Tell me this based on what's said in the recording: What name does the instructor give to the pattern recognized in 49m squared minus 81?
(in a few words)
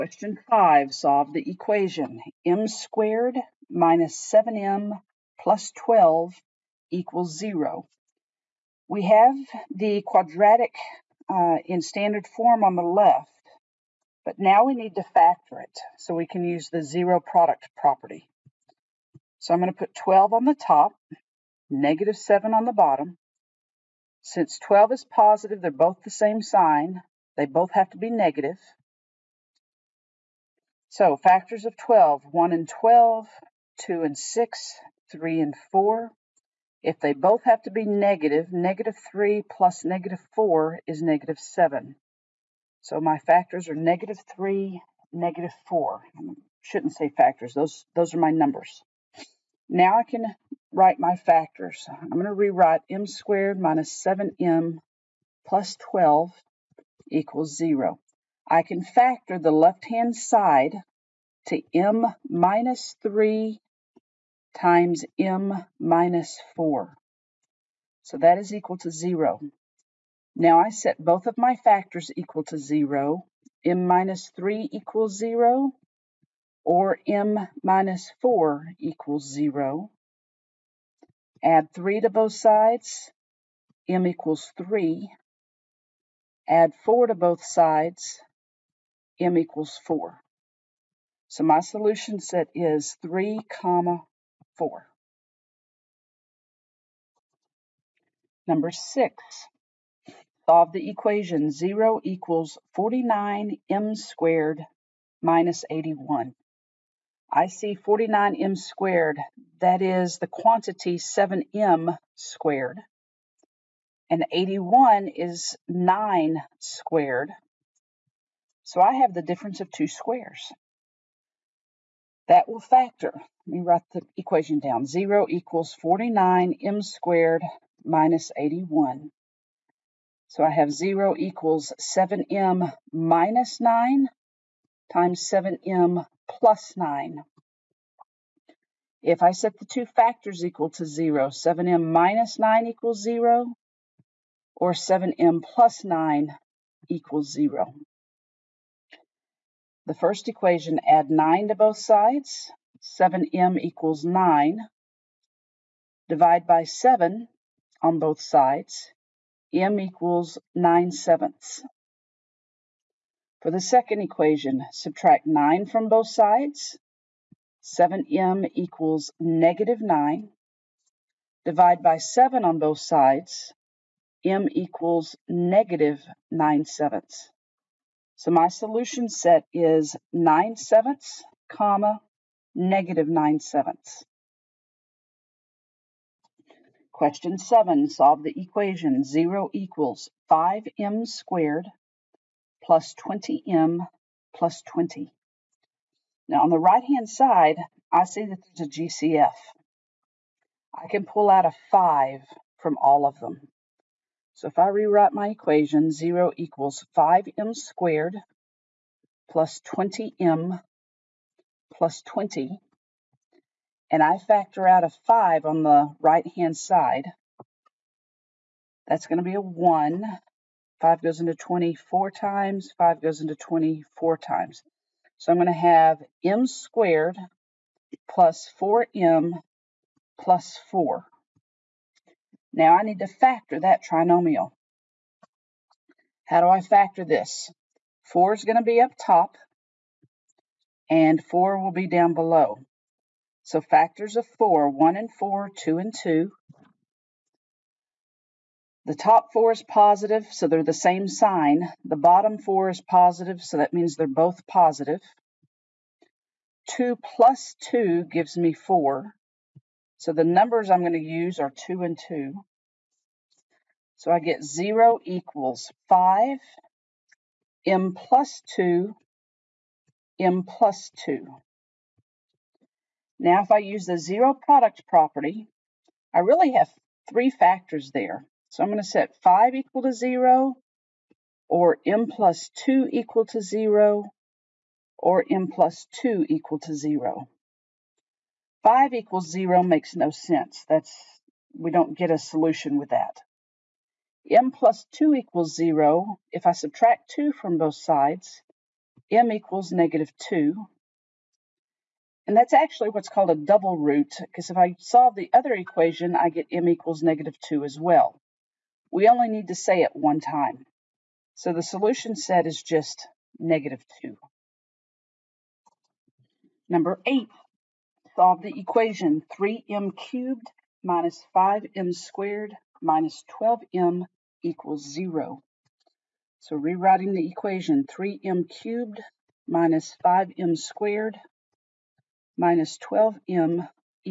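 difference of two squares.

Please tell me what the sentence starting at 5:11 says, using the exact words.
So the solution set is just negative 2.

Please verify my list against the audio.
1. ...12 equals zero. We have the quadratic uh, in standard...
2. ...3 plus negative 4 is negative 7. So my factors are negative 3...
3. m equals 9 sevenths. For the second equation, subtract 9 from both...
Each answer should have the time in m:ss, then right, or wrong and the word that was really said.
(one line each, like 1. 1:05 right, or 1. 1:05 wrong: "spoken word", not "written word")
1. 0:05 right
2. 0:39 right
3. 2:39 right.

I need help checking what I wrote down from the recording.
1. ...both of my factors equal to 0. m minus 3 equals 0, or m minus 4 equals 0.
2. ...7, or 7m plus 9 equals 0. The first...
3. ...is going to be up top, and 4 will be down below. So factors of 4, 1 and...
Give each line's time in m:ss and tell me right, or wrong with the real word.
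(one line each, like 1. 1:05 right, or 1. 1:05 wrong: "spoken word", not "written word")
1. 1:11 right
2. 2:23 wrong: "0", not "7"
3. 3:58 right.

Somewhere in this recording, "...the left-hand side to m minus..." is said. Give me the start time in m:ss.
0:59.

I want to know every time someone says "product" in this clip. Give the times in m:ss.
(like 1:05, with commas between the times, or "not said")
0:17, 4:34.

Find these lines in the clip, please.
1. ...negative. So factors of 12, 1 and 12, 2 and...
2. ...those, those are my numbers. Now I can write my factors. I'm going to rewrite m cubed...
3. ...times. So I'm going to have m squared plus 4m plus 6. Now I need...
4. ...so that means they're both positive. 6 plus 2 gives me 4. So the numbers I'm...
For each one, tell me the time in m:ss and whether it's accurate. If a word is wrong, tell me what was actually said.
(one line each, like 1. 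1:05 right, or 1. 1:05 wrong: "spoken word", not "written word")
1. 0:28 right
2. 0:47 wrong: "squared", not "cubed"
3. 3:44 wrong: "4", not "6"
4. 4:13 wrong: "2", not "6".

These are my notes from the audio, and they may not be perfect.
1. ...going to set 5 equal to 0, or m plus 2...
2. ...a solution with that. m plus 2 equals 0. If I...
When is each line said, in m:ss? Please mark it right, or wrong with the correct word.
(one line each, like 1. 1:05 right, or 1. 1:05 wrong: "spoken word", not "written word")
1. 4:38 right
2. 4:52 right.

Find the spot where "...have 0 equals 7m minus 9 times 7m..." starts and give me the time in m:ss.
2:10.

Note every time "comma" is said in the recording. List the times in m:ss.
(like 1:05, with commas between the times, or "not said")
1:33, 3:01.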